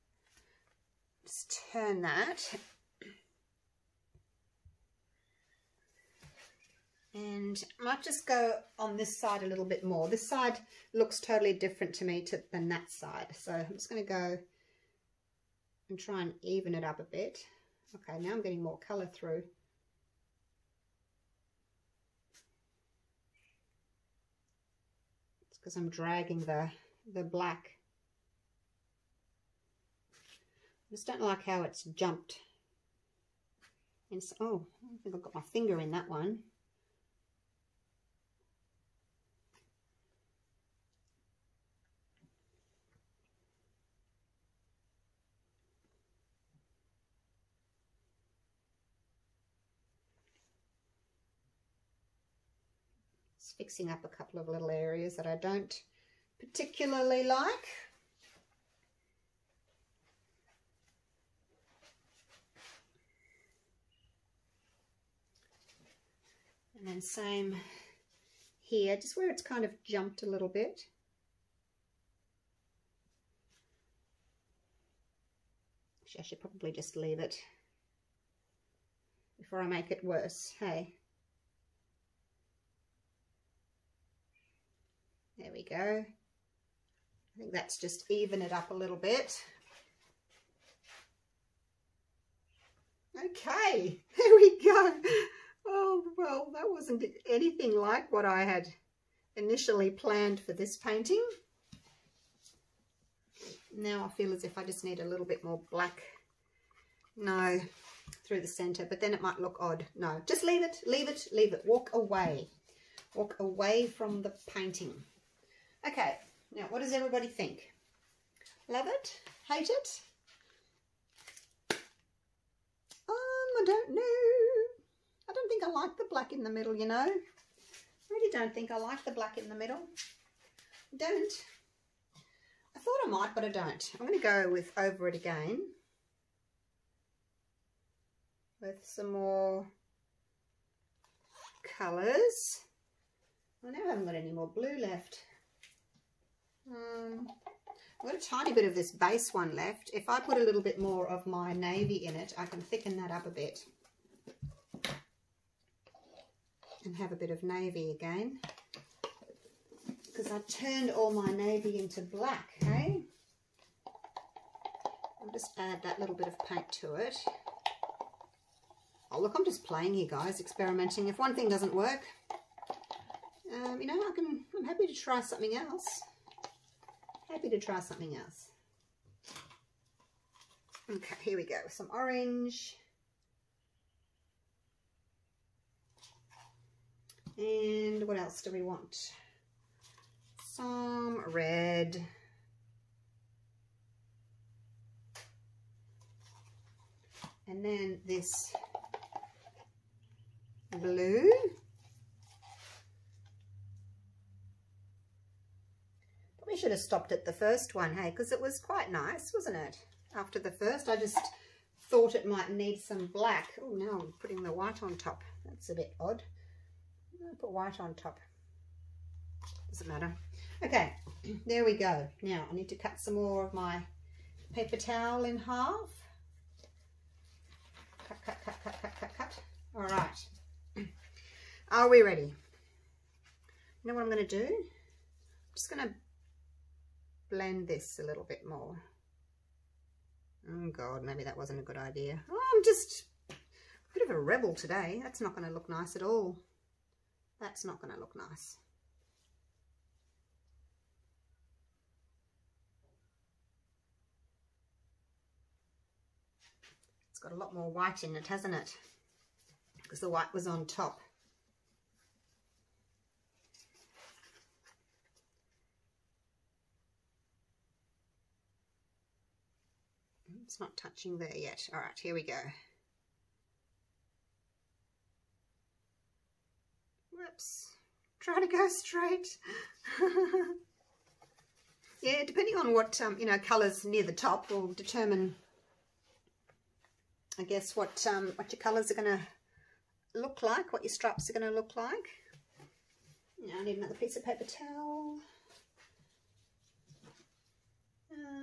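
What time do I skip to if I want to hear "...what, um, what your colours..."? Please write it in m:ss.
4:47.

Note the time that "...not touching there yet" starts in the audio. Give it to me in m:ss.
4:30.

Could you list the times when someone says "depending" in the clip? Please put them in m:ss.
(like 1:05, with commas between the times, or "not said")
4:42.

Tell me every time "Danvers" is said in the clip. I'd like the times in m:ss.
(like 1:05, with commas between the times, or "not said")
not said.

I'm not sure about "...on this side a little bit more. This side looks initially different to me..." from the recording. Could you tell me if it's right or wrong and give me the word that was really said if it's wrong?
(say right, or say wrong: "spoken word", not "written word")
wrong: "totally", not "initially".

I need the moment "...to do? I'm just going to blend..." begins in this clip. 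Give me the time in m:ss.
3:54.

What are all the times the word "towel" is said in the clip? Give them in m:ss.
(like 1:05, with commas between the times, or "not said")
3:44, 4:54.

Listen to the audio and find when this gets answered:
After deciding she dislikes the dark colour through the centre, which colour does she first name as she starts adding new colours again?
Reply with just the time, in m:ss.
3:01.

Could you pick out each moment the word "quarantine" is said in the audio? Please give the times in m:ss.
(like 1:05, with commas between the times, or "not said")
not said.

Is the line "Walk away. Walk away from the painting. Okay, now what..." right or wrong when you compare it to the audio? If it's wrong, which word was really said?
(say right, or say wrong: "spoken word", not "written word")
right.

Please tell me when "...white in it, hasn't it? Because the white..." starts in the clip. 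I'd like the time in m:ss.
4:17.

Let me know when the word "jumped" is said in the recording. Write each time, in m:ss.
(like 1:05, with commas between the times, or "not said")
0:31, 1:09.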